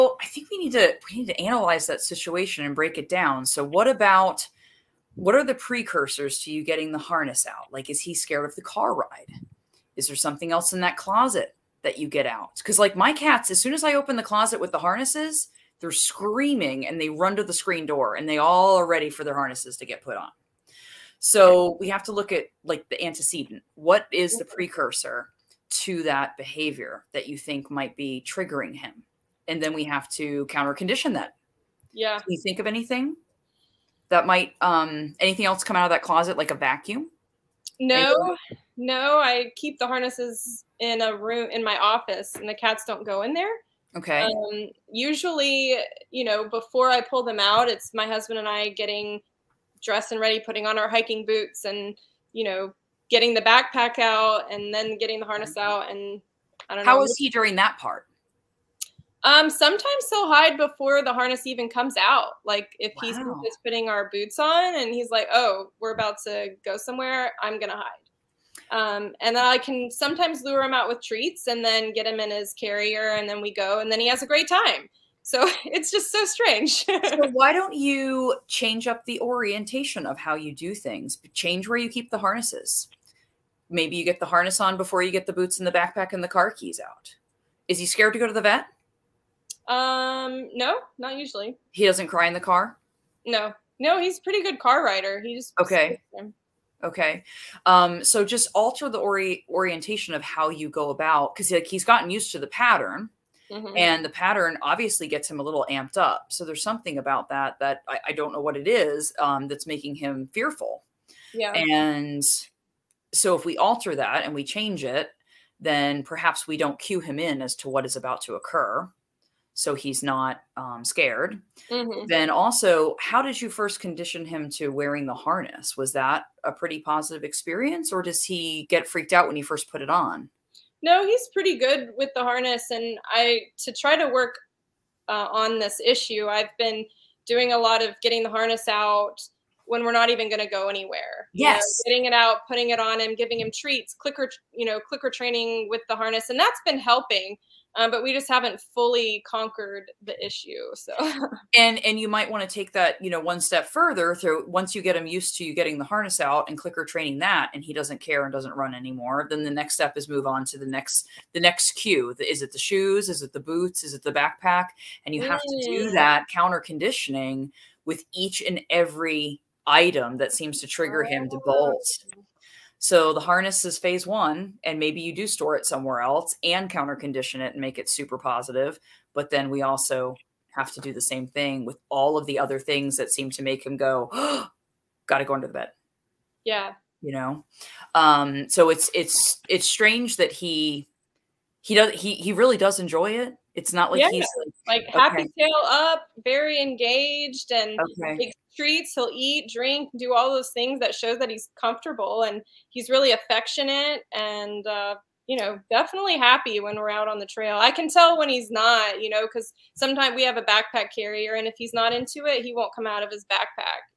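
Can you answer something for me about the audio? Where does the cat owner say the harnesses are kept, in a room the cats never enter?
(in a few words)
My office.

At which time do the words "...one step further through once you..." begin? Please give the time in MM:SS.
02:33.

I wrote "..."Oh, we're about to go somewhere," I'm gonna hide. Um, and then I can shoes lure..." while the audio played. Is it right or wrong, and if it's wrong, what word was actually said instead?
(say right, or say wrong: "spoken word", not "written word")
wrong: "sometimes", not "shoes".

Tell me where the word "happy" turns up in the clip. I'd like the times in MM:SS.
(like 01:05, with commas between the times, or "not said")
03:14, 03:26.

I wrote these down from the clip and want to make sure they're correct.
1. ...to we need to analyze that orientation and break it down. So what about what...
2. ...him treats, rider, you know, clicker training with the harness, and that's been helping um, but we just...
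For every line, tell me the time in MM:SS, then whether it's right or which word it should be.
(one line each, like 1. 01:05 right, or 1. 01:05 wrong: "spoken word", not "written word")
1. 00:00 wrong: "situation", not "orientation"
2. 02:23 wrong: "clicker", not "rider".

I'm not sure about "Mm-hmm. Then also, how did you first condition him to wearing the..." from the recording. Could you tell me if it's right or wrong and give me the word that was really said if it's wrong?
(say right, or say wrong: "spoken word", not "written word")
right.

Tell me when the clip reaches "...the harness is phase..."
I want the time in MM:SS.
02:53.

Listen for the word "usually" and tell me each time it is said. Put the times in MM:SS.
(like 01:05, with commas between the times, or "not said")
00:44, 01:31.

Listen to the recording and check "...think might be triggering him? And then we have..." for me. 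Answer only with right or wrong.
right.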